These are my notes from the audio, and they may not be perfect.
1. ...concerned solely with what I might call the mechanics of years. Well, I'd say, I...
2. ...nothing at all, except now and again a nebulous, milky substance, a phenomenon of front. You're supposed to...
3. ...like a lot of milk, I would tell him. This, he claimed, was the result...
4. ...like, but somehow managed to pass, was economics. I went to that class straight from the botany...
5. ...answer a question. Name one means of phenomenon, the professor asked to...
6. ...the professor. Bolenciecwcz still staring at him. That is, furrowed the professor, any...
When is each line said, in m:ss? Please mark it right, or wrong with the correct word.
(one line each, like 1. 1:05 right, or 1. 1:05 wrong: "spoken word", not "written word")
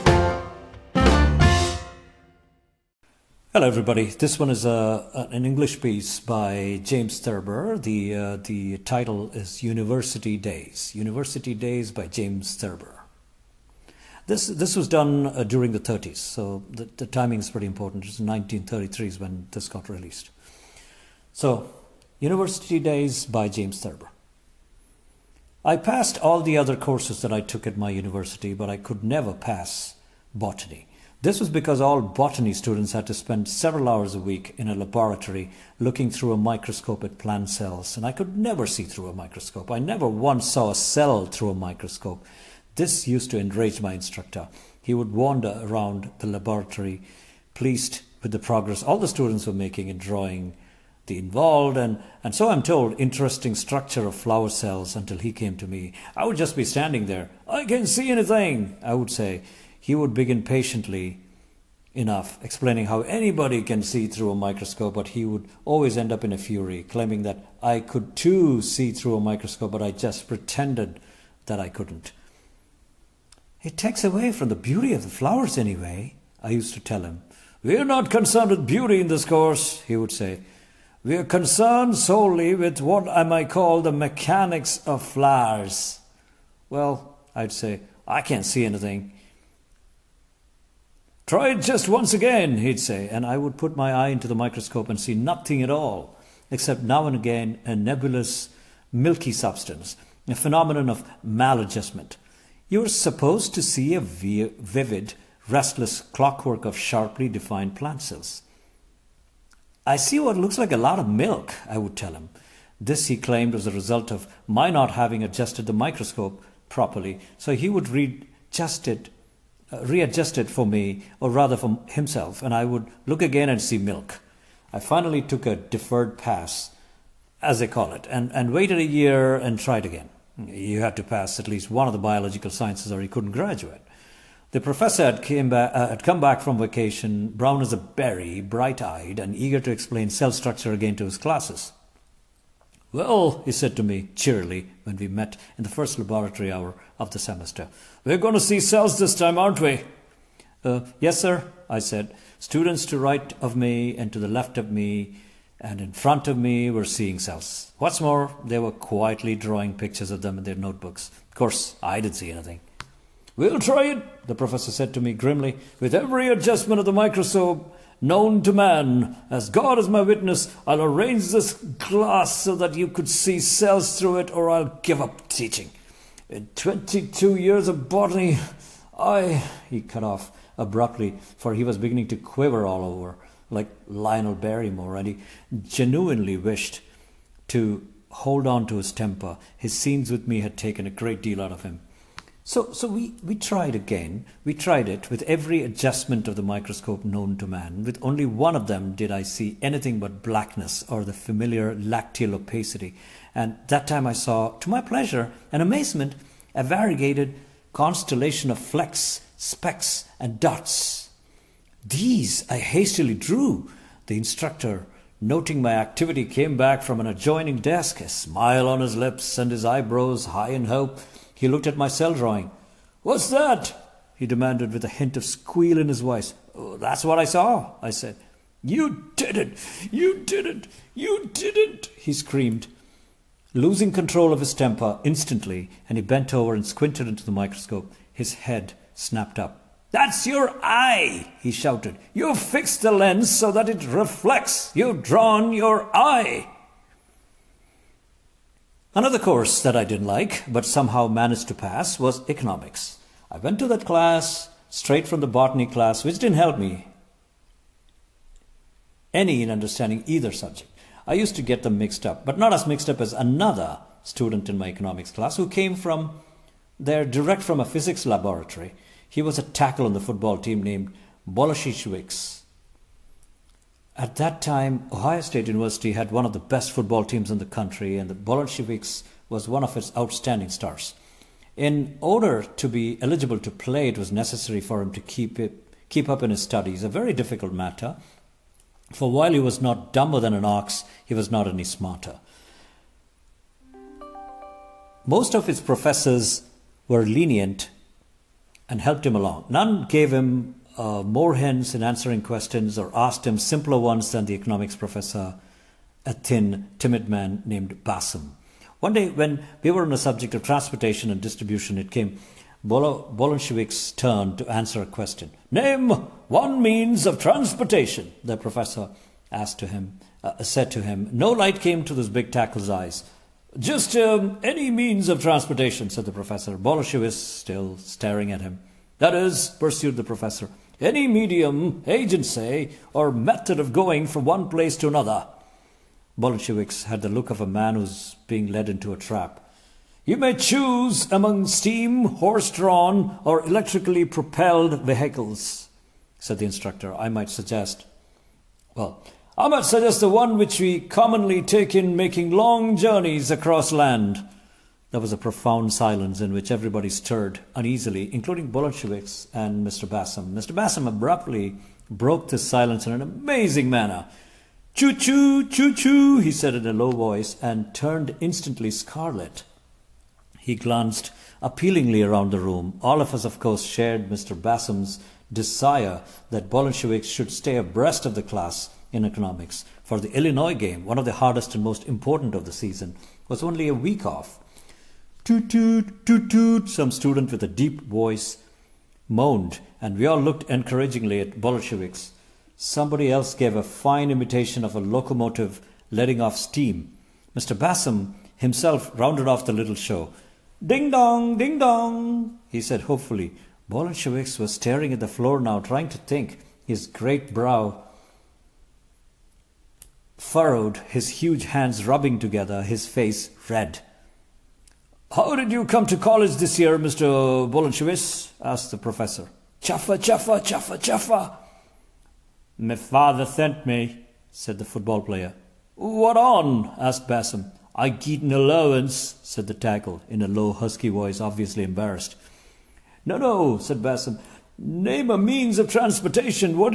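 1. 1:21 wrong: "flowers", not "years"
2. 1:35 wrong: "maladjustment", not "front"
3. 1:50 right
4. 4:10 right
5. 5:14 wrong: "transportation", not "phenomenon"
6. 5:26 wrong: "pursued", not "furrowed".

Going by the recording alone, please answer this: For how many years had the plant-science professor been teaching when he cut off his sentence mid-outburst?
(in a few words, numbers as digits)
22.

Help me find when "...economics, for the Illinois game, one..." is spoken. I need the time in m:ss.
6:19.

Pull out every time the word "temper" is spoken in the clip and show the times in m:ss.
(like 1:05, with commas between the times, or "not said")
3:08, 3:54.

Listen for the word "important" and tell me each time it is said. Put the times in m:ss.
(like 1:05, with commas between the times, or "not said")
0:17, 6:21.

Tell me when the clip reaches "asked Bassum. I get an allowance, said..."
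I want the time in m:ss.
7:06.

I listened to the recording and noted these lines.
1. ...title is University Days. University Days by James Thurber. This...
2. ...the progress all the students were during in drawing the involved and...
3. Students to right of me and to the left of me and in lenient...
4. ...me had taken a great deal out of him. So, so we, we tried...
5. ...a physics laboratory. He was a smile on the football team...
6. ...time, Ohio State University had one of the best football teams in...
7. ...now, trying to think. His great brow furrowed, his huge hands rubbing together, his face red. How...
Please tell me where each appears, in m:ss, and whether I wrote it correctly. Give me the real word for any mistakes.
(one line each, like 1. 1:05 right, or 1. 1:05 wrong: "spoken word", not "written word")
1. 0:08 right
2. 0:48 wrong: "making", not "during"
3. 2:32 wrong: "front", not "lenient"
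4. 3:10 right
5. 4:27 wrong: "tackle", not "smile"
6. 4:34 right
7. 6:45 right.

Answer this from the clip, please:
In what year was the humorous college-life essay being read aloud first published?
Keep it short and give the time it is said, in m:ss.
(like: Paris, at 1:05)
1933, at 0:18.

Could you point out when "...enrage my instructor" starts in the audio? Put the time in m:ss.
0:43.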